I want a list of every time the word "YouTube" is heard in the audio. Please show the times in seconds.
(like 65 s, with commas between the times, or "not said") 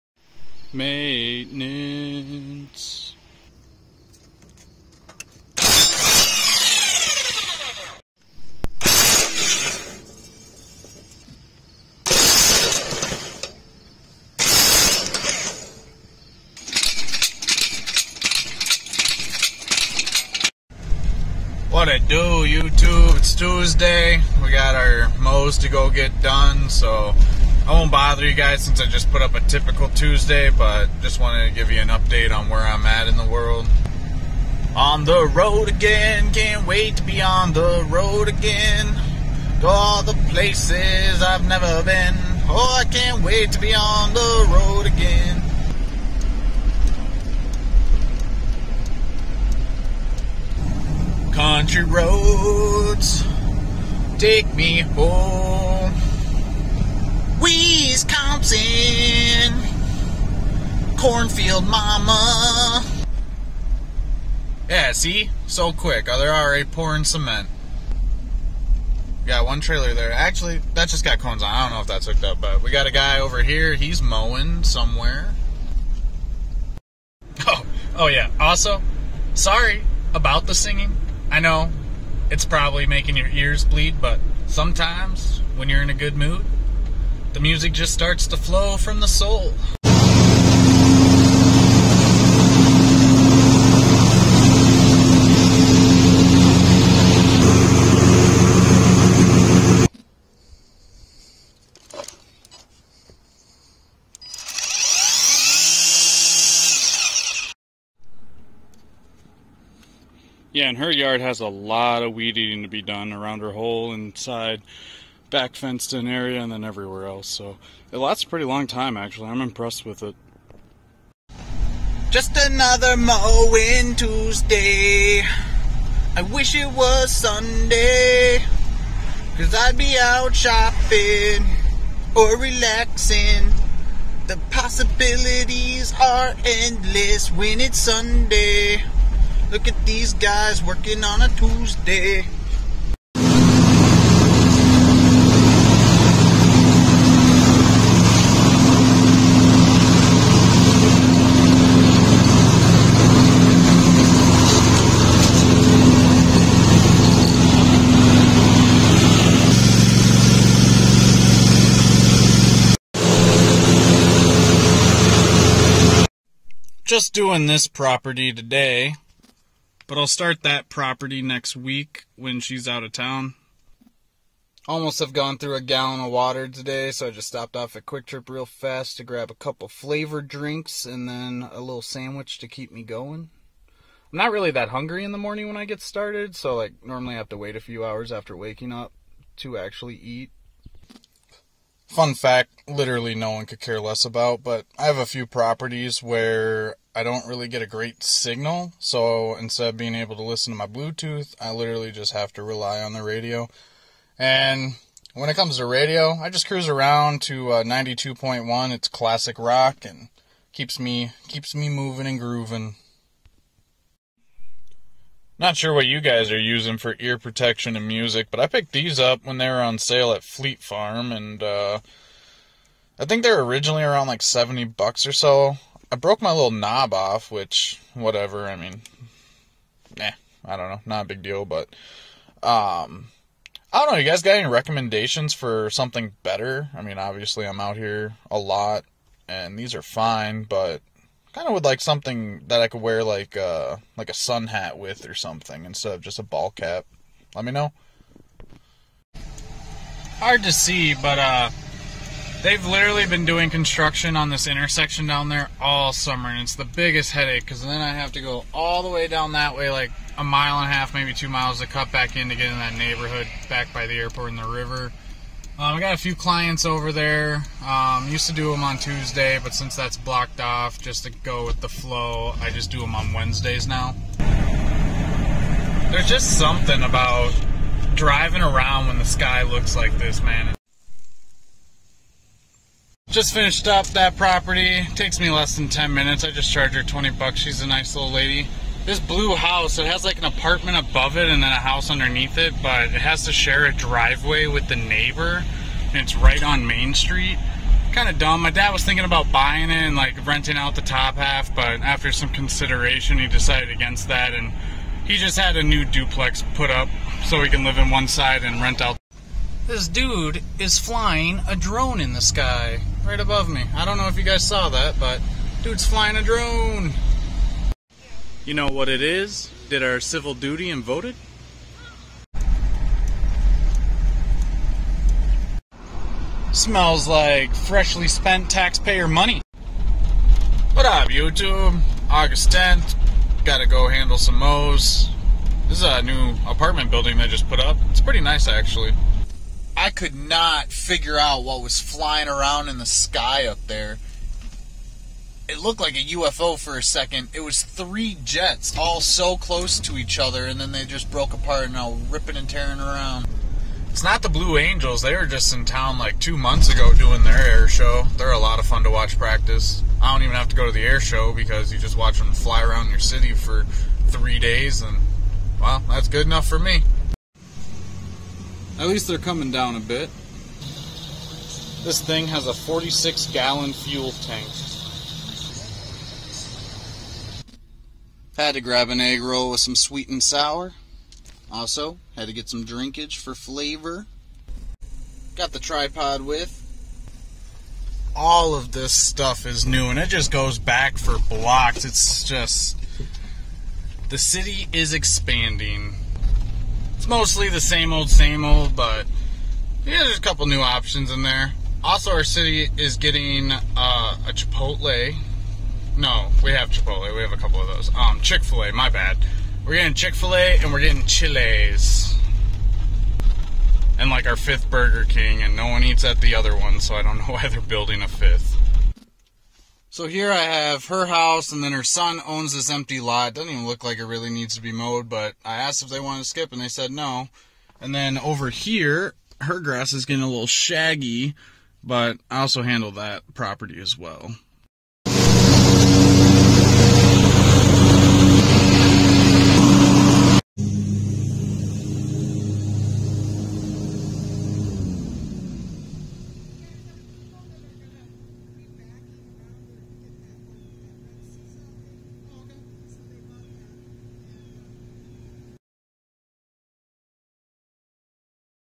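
22 s, 331 s.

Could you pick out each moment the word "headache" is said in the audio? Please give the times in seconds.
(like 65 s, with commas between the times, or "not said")
257 s.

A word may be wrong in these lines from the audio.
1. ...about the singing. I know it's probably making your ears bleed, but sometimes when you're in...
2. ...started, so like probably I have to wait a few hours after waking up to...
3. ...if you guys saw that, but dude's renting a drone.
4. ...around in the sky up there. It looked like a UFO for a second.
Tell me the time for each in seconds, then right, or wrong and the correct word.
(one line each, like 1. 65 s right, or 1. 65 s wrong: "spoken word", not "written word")
1. 80 s right
2. 185 s wrong: "normally", not "probably"
3. 314 s wrong: "flying", not "renting"
4. 342 s right.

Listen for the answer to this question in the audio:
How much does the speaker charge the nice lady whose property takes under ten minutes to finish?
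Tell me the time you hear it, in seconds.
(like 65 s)
286 s.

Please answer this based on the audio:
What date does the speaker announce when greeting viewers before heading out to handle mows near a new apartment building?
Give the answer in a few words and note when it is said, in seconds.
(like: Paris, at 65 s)
August 10th, at 332 s.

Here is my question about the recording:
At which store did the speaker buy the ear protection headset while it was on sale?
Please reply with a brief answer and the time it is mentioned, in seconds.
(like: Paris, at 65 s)
Fleet Farm, at 220 s.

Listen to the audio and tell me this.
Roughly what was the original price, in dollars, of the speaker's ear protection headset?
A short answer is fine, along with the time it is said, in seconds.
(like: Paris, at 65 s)
70, at 224 s.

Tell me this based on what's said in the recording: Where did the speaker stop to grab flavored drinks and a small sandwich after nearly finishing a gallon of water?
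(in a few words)
QuikTrip.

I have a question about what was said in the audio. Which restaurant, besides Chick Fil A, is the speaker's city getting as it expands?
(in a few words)
Chili's.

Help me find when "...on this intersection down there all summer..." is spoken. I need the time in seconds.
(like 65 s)
254 s.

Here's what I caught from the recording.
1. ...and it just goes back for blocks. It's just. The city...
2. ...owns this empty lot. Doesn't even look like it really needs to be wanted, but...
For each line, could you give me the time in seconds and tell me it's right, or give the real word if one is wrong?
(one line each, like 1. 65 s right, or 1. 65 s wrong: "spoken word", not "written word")
1. 389 s right
2. 422 s wrong: "mowed", not "wanted".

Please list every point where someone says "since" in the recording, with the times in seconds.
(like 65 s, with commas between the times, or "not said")
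28 s, 269 s.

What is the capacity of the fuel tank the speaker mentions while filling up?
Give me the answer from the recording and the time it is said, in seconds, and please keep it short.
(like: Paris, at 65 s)
46 gallons, at 372 s.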